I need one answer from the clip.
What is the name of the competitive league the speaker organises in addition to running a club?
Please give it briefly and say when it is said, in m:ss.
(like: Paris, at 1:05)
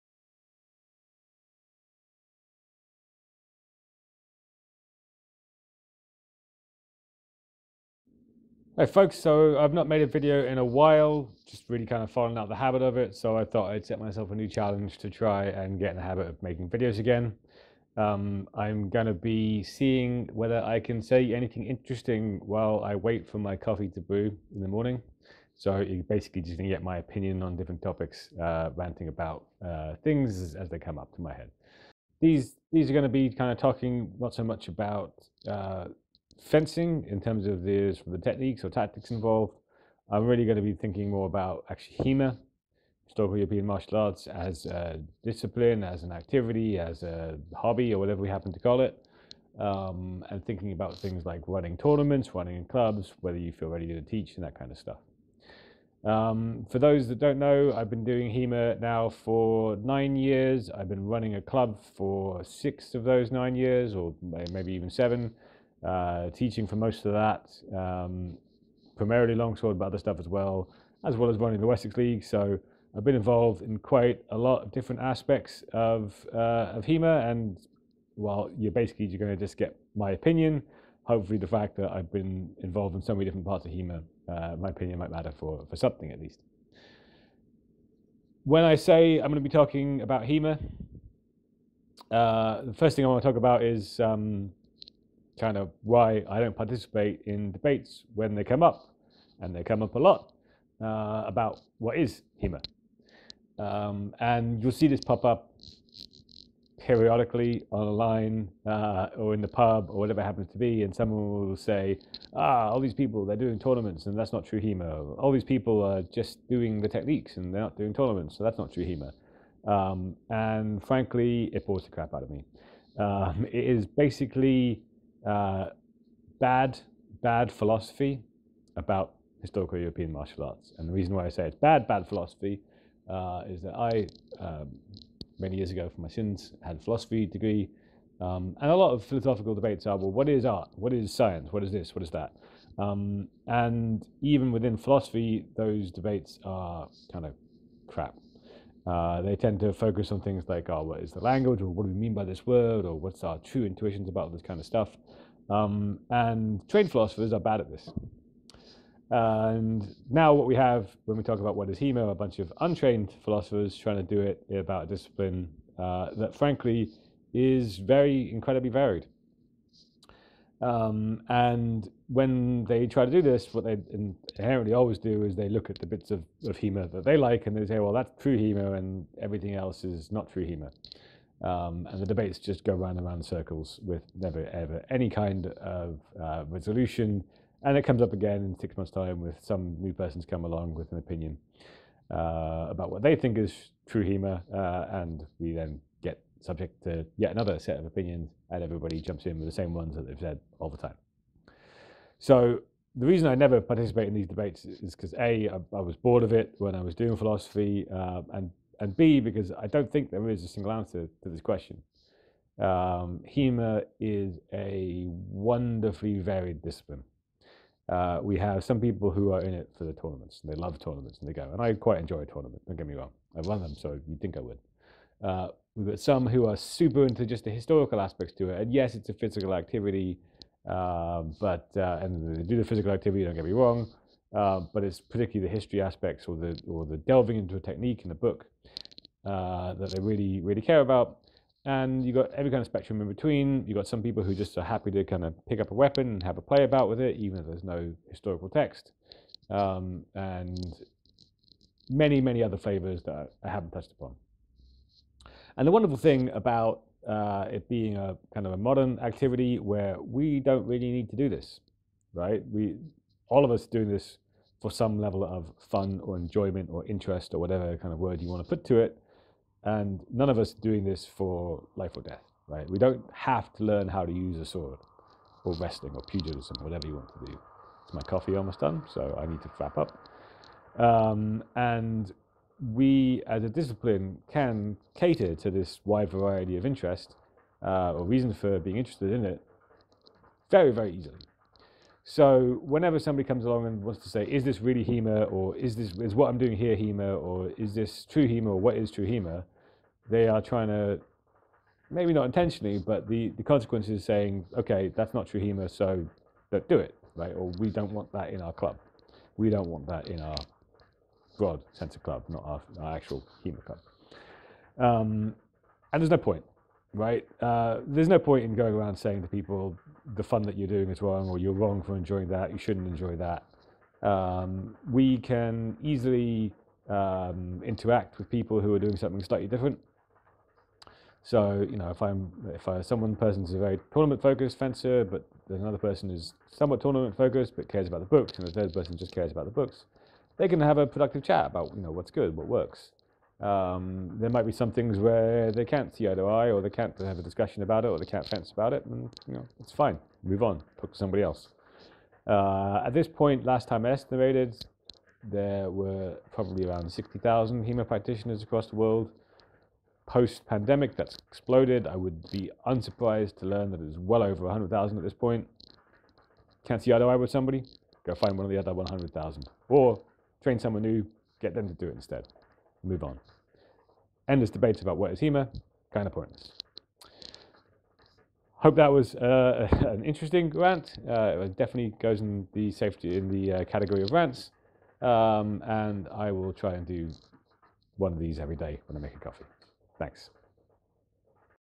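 Wessex League, at 1:11.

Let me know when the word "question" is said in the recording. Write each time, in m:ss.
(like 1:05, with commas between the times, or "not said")
3:31.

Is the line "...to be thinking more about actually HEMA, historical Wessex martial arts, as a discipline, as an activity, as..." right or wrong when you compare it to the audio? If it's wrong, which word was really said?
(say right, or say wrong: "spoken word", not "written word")
wrong: "European", not "Wessex".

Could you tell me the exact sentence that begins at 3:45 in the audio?
Uh, We've got some who are super into just the historical aspects to it.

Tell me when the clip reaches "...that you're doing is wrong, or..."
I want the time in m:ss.
5:20.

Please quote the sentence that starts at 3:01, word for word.
Um, and the debates just go round and round circles with never ever any kind of uh, resolution.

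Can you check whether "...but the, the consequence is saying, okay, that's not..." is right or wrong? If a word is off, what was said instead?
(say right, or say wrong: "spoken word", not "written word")
right.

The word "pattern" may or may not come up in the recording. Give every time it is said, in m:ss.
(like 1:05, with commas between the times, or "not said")
not said.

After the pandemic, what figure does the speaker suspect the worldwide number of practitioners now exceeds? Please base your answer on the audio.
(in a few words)
100,000.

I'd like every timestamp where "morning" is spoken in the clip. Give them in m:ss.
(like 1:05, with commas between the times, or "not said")
0:24.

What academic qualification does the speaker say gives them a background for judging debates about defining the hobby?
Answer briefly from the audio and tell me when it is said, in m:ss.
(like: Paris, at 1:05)
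Philosophy degree, at 2:16.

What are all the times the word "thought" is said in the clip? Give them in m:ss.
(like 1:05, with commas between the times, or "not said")
0:13.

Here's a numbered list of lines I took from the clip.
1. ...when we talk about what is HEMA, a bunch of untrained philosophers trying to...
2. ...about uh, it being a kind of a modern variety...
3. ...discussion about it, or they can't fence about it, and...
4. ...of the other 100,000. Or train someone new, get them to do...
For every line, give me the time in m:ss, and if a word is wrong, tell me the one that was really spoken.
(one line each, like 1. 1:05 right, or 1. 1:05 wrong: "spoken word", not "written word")
1. 2:41 right
2. 4:16 wrong: "activity", not "variety"
3. 5:47 right
4. 6:08 right.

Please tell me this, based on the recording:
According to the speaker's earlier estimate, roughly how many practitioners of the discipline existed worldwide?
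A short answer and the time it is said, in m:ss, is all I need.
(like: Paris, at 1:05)
60,000, at 5:56.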